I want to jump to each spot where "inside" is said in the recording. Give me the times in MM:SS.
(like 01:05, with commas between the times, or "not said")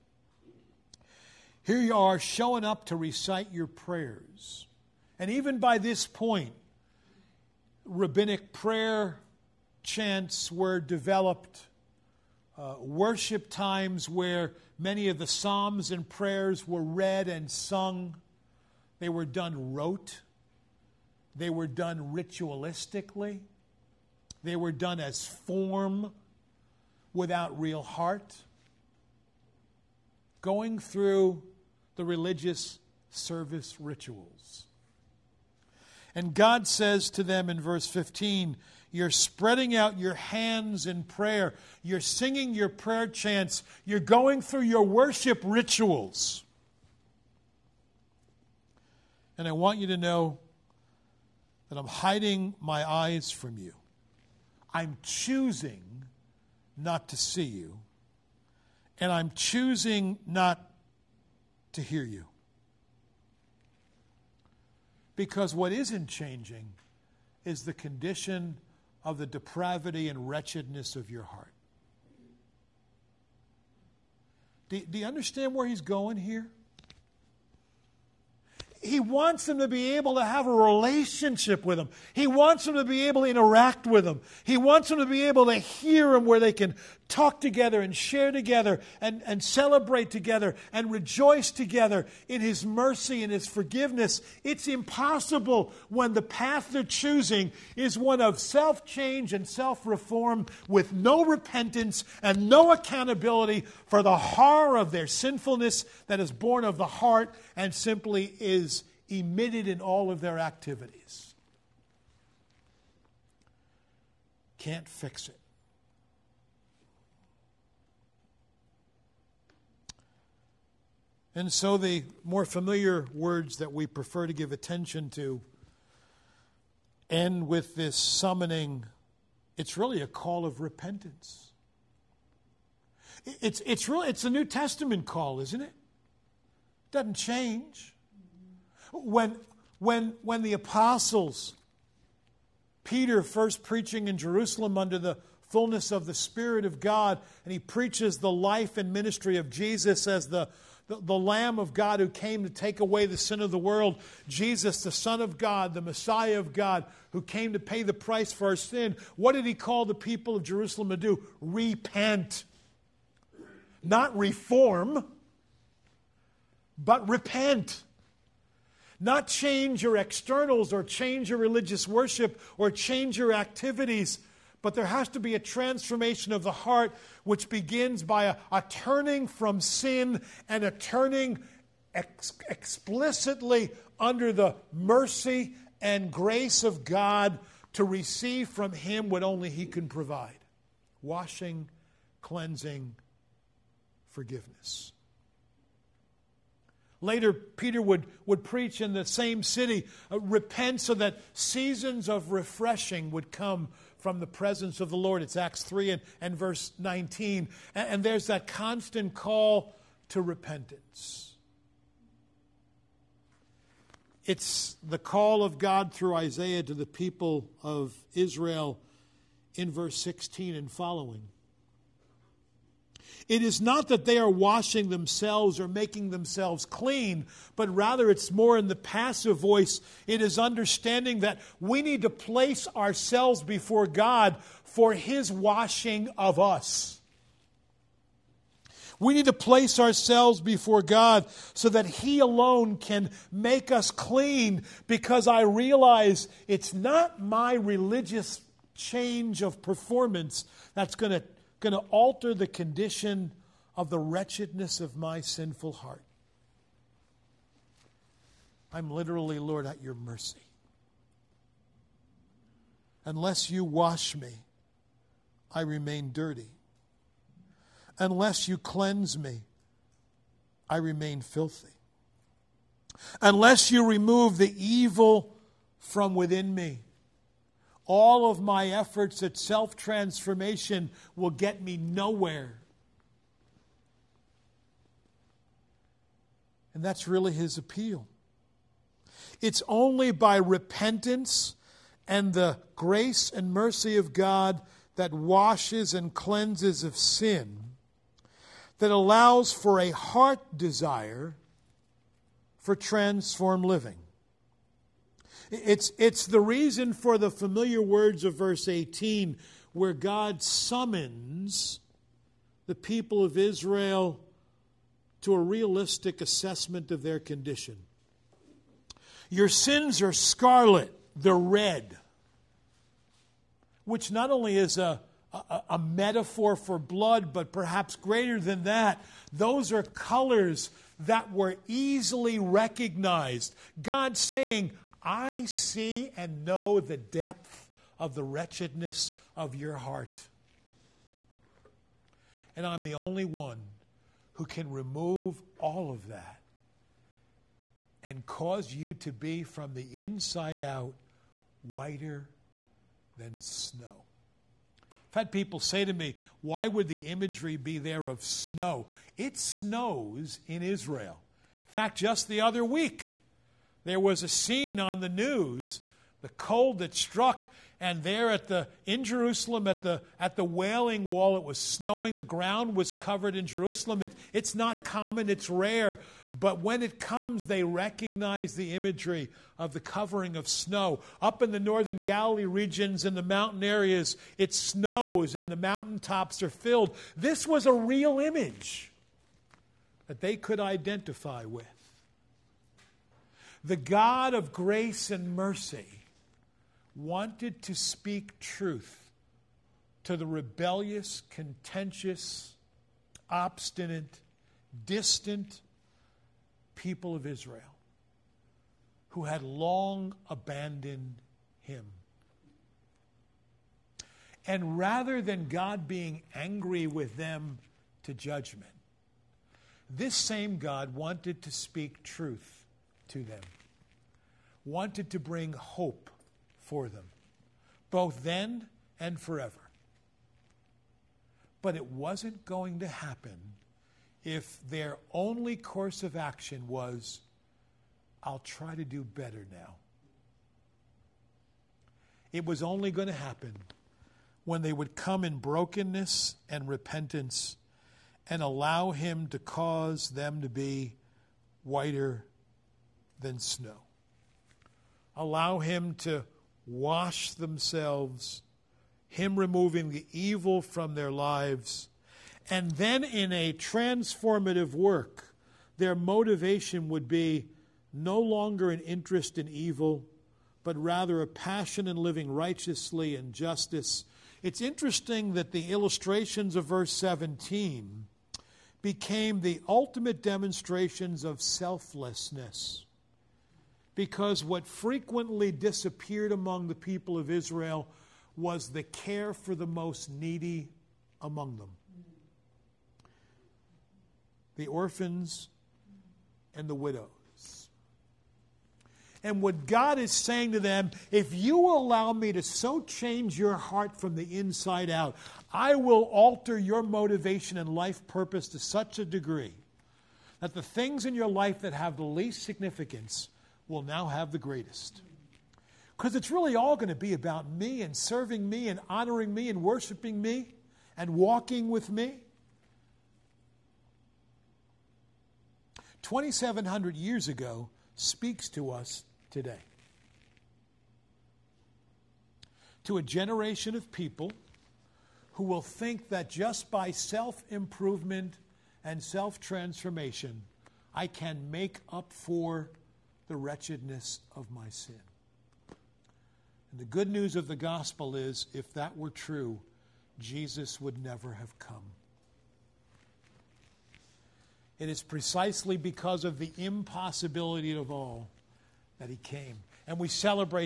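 05:49, 08:24.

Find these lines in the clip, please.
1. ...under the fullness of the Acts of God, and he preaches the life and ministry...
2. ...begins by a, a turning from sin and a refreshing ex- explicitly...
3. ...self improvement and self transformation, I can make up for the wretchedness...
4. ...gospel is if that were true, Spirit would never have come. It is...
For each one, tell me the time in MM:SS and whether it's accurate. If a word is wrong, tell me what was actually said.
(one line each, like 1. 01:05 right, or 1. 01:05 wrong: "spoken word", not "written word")
1. 02:24 wrong: "Spirit", not "Acts"
2. 02:57 wrong: "turning", not "refreshing"
3. 08:56 right
4. 09:07 wrong: "Jesus", not "Spirit".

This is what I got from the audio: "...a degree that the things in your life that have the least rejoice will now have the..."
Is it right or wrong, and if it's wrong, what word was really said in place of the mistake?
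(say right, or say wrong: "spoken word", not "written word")
wrong: "significance", not "rejoice".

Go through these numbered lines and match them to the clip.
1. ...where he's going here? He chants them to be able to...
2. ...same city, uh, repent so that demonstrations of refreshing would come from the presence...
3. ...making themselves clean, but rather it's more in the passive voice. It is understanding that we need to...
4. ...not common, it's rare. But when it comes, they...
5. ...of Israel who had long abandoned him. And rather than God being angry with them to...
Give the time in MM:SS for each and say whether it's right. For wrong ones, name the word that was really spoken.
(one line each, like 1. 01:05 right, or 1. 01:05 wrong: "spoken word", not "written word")
1. 01:15 wrong: "wants", not "chants"
2. 03:19 wrong: "seasons", not "demonstrations"
3. 03:45 right
4. 06:14 right
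5. 06:47 right.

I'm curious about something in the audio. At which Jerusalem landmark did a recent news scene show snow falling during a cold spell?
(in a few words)
The Wailing Wall.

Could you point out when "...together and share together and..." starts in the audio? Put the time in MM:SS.
01:27.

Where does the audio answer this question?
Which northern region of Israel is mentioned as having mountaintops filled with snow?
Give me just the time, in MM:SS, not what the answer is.
06:22.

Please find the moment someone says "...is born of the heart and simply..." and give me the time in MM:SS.
01:46.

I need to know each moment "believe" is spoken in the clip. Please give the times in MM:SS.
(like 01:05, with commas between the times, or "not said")
not said.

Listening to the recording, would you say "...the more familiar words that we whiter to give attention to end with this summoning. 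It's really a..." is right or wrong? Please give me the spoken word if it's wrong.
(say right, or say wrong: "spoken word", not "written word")
wrong: "prefer", not "whiter".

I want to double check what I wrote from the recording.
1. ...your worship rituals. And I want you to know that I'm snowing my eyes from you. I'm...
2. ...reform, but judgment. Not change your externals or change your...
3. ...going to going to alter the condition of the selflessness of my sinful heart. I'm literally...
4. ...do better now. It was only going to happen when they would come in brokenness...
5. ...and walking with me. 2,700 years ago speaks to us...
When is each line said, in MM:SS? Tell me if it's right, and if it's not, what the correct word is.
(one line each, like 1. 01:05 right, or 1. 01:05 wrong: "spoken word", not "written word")
1. 00:44 wrong: "hiding", not "snowing"
2. 02:44 wrong: "repent", not "judgment"
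3. 04:10 wrong: "wretchedness", not "selflessness"
4. 07:18 right
5. 08:40 right.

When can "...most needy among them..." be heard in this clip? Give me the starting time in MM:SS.
08:09.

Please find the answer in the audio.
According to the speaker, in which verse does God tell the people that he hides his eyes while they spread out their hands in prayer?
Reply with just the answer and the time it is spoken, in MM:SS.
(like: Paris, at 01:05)
Verse 15, at 00:37.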